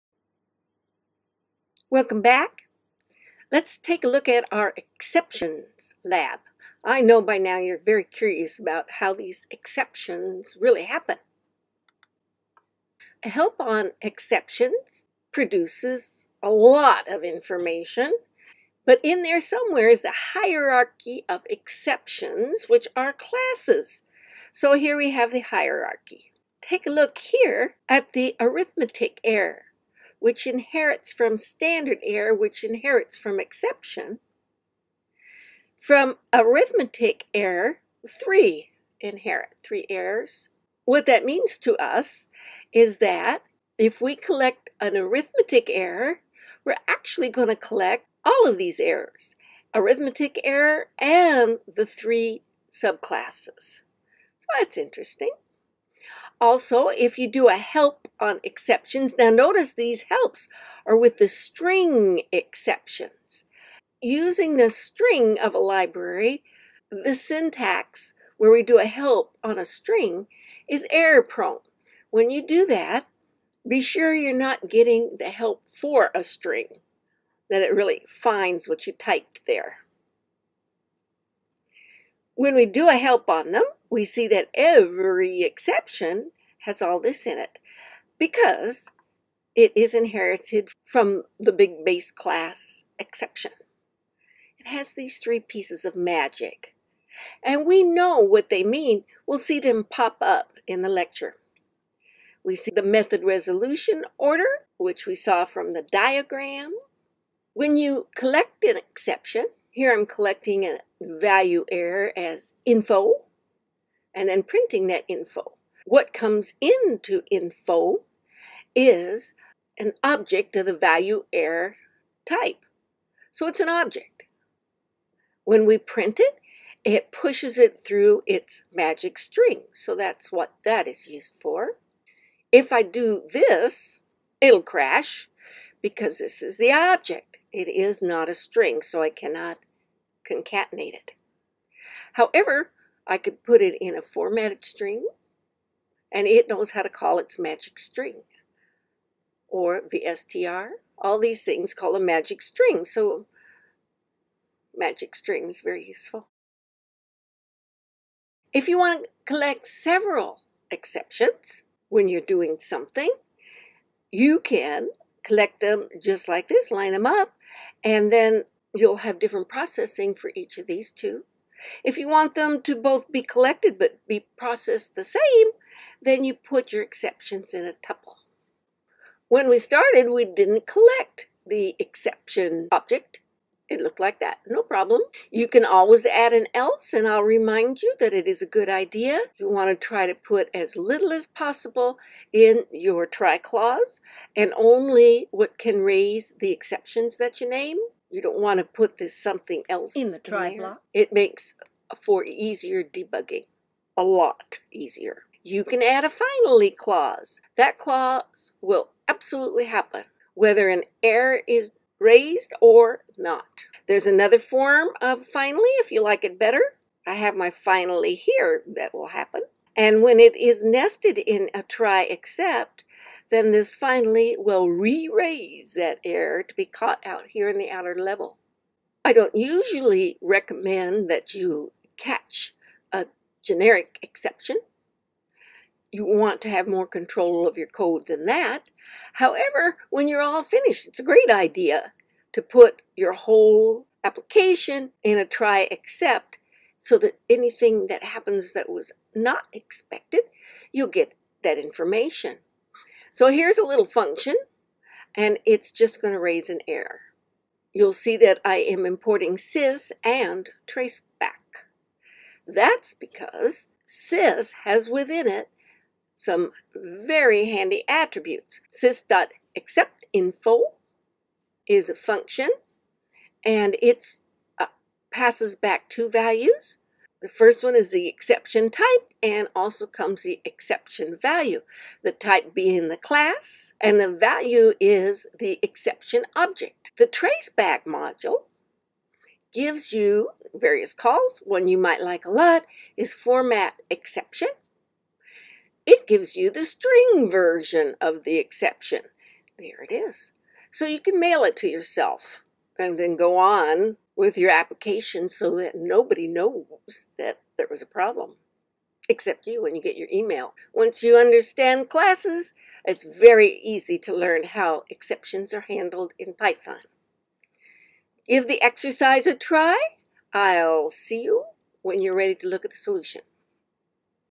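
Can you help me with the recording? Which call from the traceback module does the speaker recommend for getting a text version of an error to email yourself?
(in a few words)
format exception.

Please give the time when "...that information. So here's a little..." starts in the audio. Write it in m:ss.
4:11.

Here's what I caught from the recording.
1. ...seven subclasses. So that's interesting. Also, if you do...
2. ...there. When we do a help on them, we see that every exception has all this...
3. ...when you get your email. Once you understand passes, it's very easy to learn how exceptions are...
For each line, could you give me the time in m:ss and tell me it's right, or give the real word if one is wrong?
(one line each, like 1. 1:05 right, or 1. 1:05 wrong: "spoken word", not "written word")
1. 0:51 wrong: "three", not "seven"
2. 1:19 right
3. 5:09 wrong: "classes", not "passes".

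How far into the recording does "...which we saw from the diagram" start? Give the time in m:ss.
1:44.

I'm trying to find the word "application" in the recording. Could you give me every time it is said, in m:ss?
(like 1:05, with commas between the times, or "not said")
4:04, 5:04.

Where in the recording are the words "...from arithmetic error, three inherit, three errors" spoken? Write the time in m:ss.
0:35.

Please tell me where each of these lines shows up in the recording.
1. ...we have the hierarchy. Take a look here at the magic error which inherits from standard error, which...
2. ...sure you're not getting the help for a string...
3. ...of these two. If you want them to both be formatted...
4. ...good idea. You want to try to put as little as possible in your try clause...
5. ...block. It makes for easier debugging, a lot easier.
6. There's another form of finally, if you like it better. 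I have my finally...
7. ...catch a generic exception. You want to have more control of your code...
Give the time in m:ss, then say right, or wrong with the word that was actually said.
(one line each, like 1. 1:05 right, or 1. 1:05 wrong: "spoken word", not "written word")
1. 0:24 wrong: "arithmetic", not "magic"
2. 1:13 right
3. 2:50 wrong: "collected", not "formatted"
4. 3:08 right
5. 3:20 right
6. 3:33 right
7. 3:51 right.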